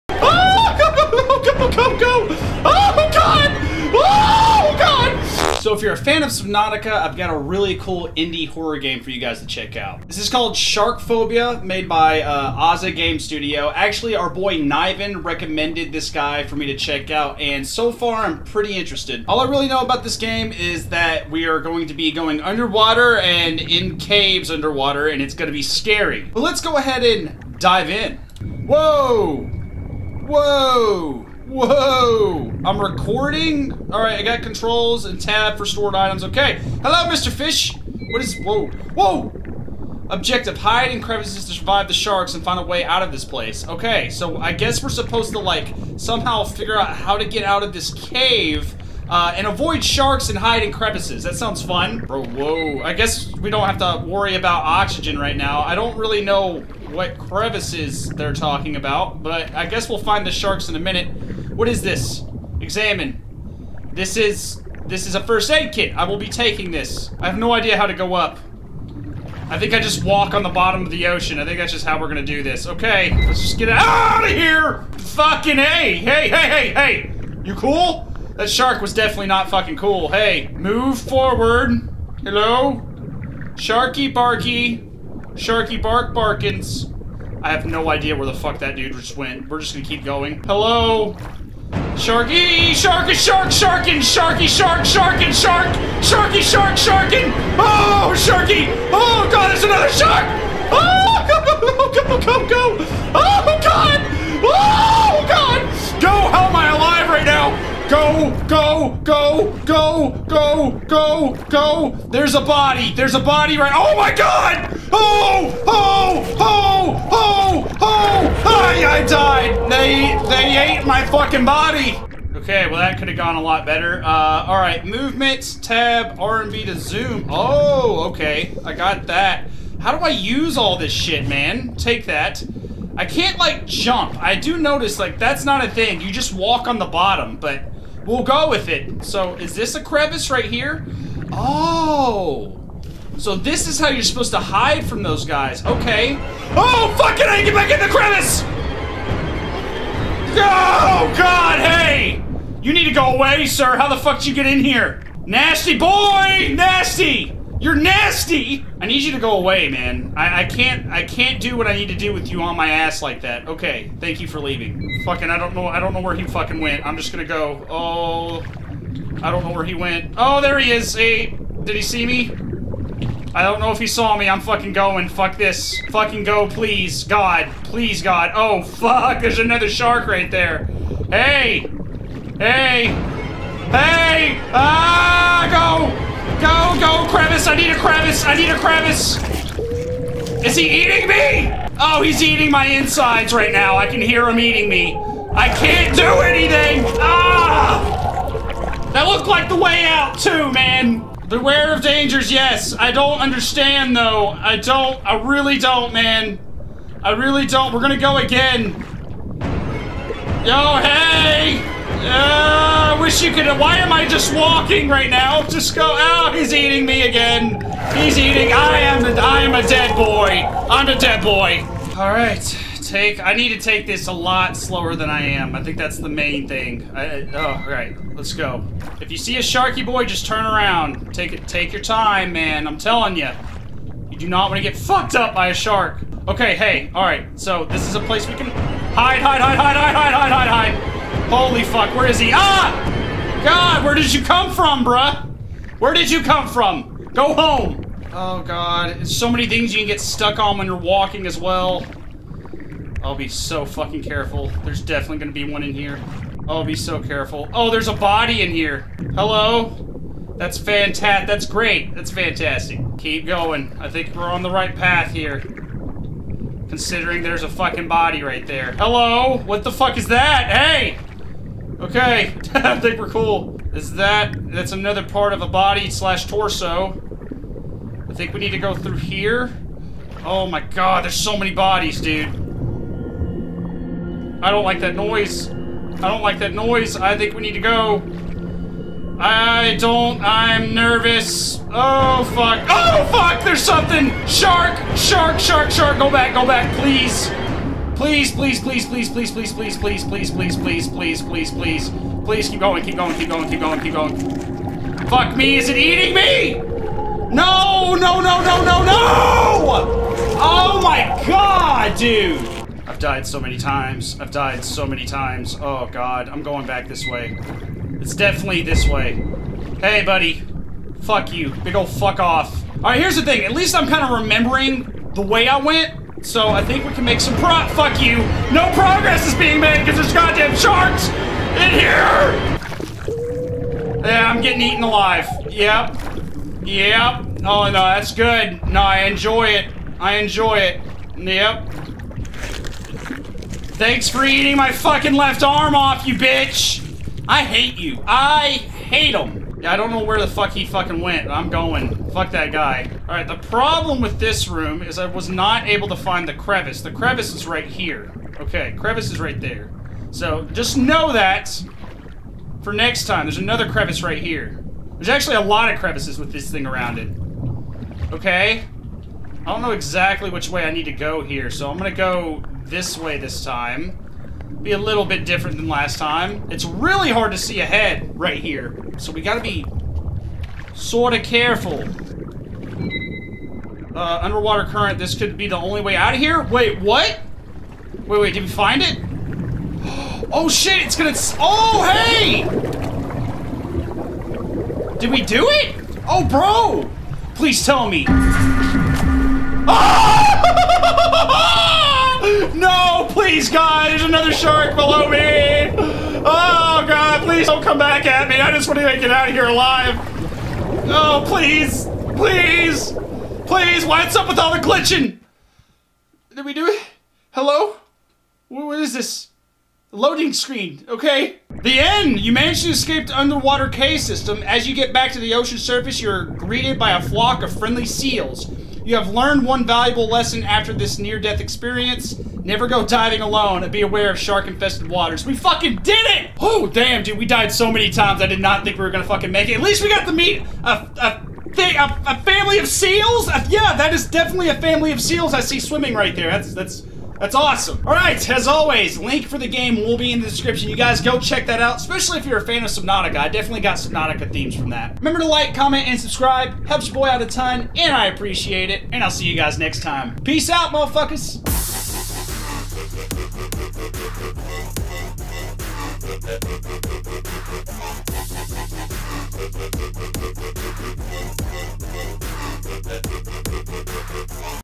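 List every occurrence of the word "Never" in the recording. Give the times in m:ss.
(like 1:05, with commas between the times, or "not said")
7:12.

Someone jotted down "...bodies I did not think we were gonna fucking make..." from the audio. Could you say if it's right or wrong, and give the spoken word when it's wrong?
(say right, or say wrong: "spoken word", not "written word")
wrong: "times", not "bodies".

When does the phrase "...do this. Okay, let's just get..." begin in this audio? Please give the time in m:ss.
1:12.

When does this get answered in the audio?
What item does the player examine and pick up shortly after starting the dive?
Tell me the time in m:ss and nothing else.
1:05.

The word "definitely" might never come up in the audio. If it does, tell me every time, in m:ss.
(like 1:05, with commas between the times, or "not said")
1:18, 4:14, 5:18, 7:24, 7:33.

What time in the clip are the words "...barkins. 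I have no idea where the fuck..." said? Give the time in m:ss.
1:26.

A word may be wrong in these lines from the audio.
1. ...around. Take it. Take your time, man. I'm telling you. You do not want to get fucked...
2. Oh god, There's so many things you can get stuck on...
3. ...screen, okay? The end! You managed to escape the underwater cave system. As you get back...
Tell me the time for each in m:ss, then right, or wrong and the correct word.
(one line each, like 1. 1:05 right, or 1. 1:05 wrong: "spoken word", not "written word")
1. 3:50 right
2. 4:08 right
3. 7:00 right.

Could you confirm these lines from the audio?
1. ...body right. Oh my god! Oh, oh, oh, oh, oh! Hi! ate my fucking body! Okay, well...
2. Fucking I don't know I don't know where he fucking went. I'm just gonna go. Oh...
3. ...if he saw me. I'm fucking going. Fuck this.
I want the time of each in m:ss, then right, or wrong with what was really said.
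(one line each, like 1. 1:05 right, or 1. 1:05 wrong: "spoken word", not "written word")
1. 1:53 right
2. 2:45 right
3. 2:53 right.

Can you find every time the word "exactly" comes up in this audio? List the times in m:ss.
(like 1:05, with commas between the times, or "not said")
6:09.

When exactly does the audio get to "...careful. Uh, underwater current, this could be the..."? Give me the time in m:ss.
6:21.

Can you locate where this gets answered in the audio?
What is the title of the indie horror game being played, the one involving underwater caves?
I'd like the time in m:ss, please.
0:10.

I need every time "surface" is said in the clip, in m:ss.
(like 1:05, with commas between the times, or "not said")
7:05.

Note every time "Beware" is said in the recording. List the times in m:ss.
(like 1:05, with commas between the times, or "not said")
3:21.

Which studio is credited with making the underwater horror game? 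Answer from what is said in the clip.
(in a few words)
Aza Game Studio.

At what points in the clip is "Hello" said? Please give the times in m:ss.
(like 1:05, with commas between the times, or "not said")
0:36, 1:22, 1:30, 4:19, 4:28, 6:57.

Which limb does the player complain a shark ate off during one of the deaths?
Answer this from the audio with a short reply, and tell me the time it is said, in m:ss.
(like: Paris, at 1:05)
left arm, at 5:45.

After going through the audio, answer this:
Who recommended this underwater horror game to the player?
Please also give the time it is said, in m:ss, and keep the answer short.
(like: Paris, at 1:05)
Niven, at 0:14.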